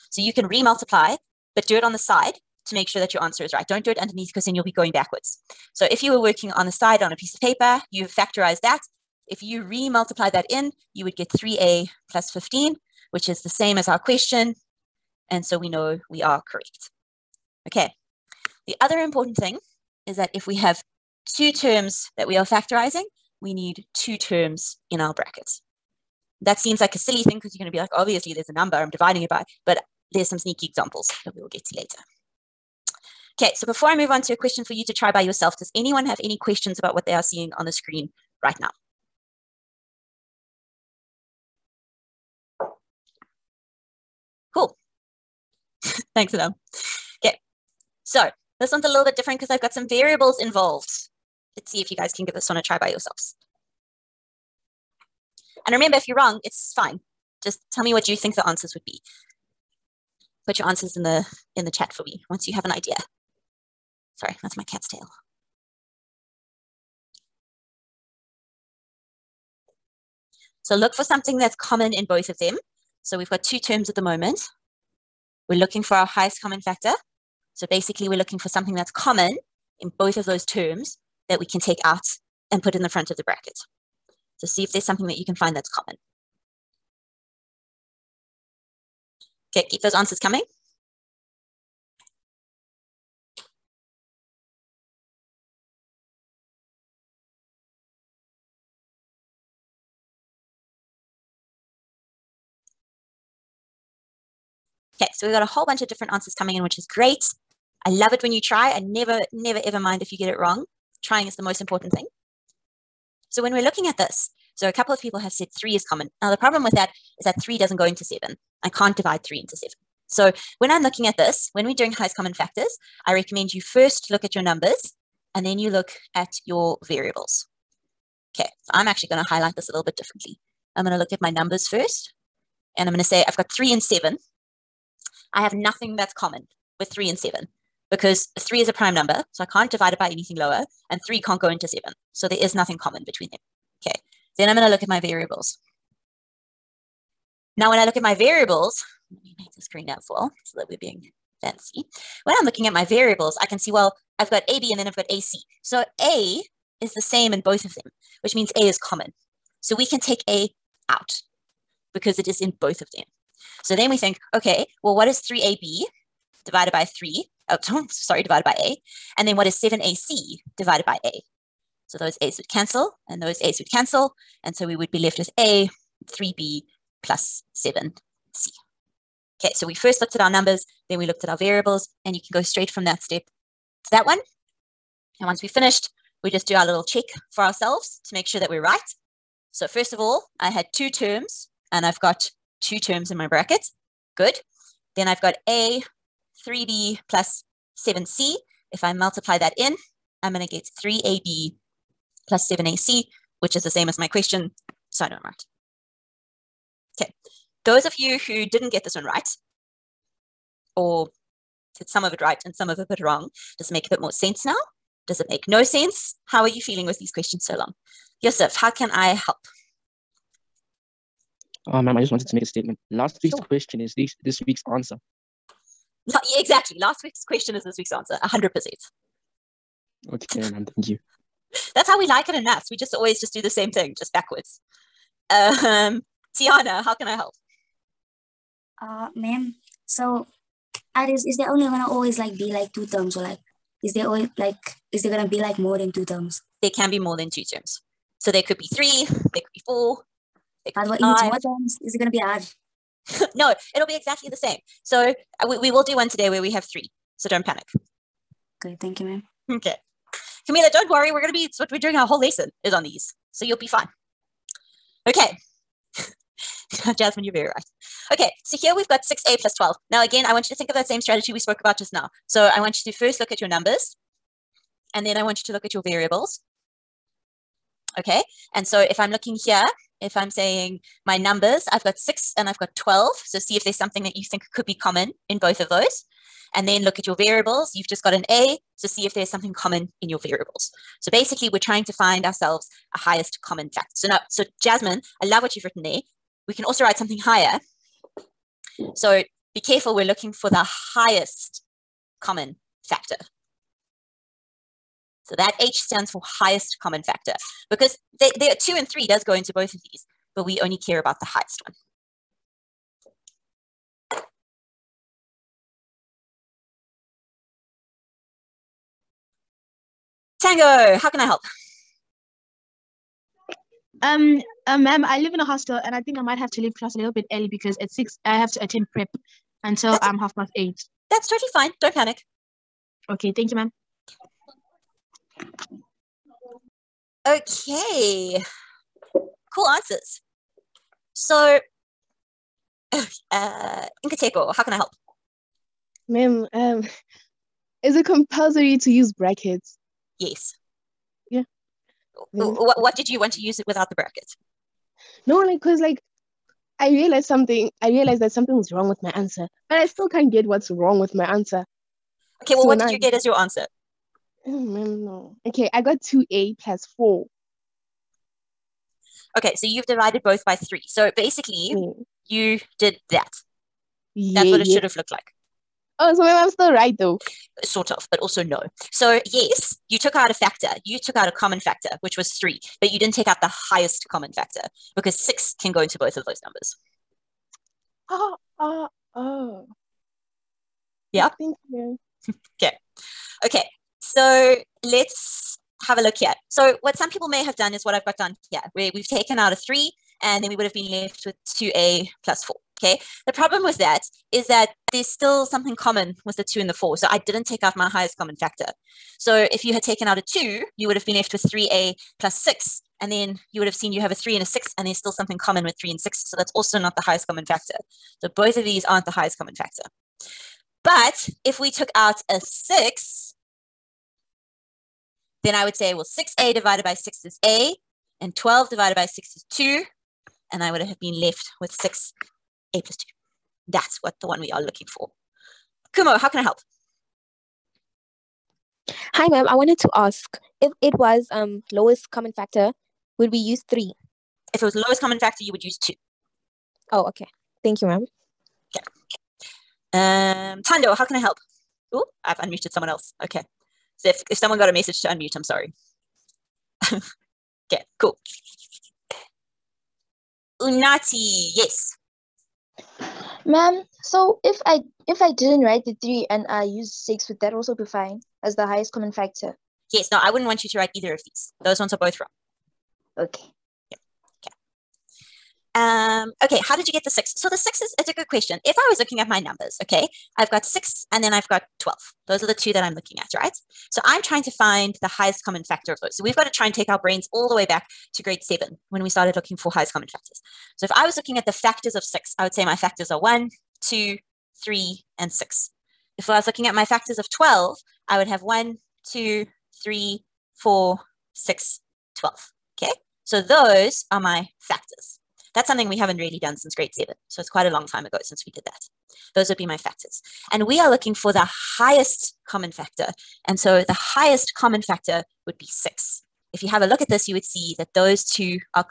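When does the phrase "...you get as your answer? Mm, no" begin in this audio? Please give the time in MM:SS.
06:02.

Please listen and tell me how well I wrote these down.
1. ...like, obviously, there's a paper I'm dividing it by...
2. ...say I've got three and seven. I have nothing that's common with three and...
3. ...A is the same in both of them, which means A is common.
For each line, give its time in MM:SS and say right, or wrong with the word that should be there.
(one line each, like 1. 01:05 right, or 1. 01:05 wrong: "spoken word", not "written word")
1. 00:27 wrong: "number", not "paper"
2. 02:13 right
3. 02:35 right.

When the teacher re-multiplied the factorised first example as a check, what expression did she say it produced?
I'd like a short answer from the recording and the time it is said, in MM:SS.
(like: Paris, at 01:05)
3a + 15, at 00:11.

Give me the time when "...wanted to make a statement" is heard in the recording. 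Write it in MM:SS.
03:42.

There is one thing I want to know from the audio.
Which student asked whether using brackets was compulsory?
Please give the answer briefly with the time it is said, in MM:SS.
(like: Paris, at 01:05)
Nkateko, at 05:44.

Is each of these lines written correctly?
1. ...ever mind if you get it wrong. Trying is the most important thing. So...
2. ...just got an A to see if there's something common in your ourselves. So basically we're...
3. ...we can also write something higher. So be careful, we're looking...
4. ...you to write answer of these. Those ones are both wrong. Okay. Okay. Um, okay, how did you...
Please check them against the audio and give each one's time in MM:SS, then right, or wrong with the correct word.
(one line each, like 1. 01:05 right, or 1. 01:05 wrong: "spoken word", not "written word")
1. 01:49 right
2. 04:47 wrong: "variables", not "ourselves"
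3. 04:56 right
4. 07:50 wrong: "either", not "answer".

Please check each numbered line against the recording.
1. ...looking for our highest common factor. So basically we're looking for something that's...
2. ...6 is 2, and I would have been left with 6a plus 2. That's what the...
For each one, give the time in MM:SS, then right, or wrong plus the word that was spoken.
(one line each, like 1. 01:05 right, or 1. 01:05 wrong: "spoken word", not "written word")
1. 01:15 right
2. 07:09 right.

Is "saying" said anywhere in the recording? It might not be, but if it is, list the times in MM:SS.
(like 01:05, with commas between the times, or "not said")
04:40.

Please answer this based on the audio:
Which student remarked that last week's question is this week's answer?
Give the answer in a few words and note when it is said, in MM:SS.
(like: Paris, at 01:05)
Yusuf, at 03:38.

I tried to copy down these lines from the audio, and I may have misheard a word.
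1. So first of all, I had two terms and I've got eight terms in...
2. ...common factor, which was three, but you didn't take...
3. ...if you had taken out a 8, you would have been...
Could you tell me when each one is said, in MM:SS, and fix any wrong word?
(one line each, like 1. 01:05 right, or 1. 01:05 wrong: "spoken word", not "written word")
1. 03:09 wrong: "two", not "eight"
2. 06:21 right
3. 06:49 wrong: "2", not "8".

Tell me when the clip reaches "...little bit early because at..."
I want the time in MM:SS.
05:26.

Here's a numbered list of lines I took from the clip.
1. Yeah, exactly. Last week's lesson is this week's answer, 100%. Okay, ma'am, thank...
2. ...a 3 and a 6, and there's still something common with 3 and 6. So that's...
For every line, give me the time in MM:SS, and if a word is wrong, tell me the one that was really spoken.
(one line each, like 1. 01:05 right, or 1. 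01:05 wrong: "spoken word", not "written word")
1. 03:46 wrong: "question", not "lesson"
2. 06:54 right.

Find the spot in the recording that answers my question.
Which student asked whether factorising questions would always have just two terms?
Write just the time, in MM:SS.
03:56.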